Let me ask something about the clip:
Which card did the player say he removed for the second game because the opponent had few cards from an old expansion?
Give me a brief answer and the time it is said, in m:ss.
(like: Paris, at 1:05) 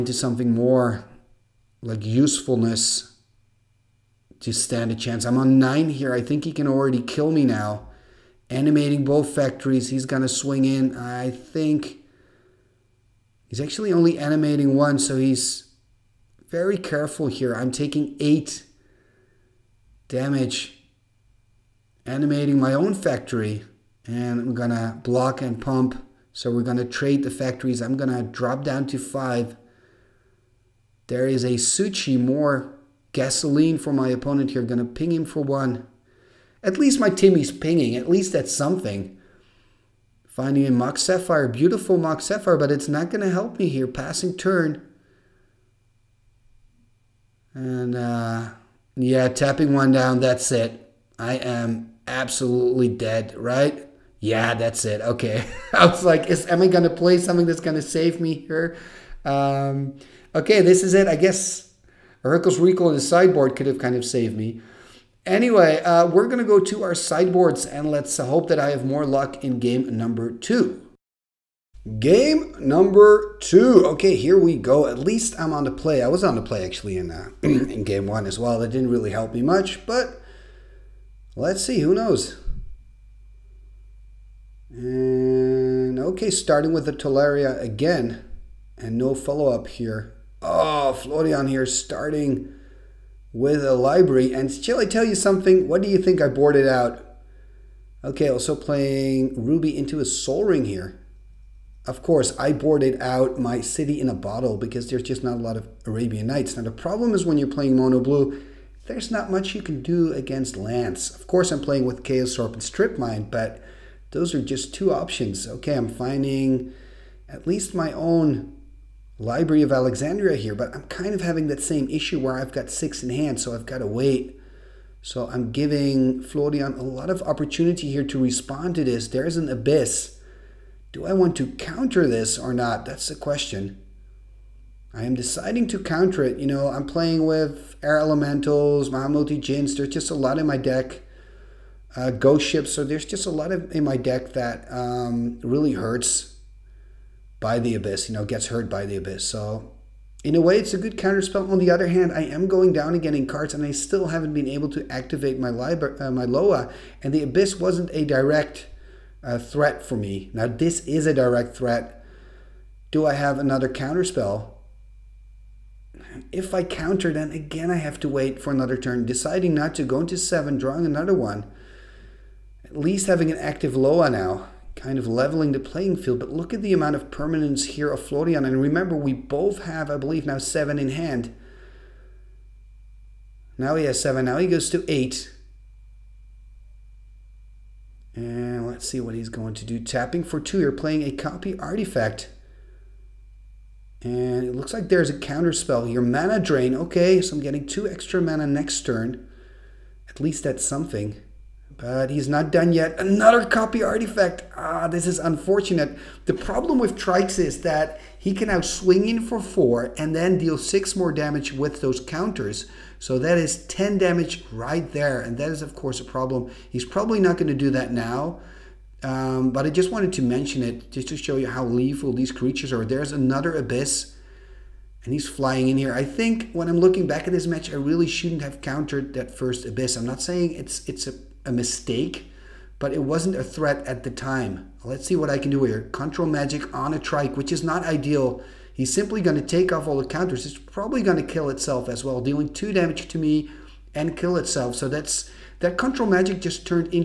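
City in a Bottle, at 1:43.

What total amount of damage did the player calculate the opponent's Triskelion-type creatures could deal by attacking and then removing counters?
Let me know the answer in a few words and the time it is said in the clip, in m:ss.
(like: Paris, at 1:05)
10, at 3:33.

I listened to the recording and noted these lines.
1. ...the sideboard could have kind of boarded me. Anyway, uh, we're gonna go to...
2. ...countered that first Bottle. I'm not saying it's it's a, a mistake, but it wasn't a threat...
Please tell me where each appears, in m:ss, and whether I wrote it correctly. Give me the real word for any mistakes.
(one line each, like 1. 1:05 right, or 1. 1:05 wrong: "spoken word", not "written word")
1. 1:02 wrong: "saved", not "boarded"
2. 3:48 wrong: "Abyss", not "Bottle".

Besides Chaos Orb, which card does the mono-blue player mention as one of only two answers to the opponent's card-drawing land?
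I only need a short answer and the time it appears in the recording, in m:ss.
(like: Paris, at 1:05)
Strip Mine, at 1:52.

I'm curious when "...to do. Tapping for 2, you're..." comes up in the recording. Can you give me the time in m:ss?
3:09.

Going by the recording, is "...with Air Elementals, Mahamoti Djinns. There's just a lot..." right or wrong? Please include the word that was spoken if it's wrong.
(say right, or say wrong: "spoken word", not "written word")
right.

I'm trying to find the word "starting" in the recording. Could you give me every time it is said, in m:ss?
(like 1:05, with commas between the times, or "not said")
1:26, 1:31.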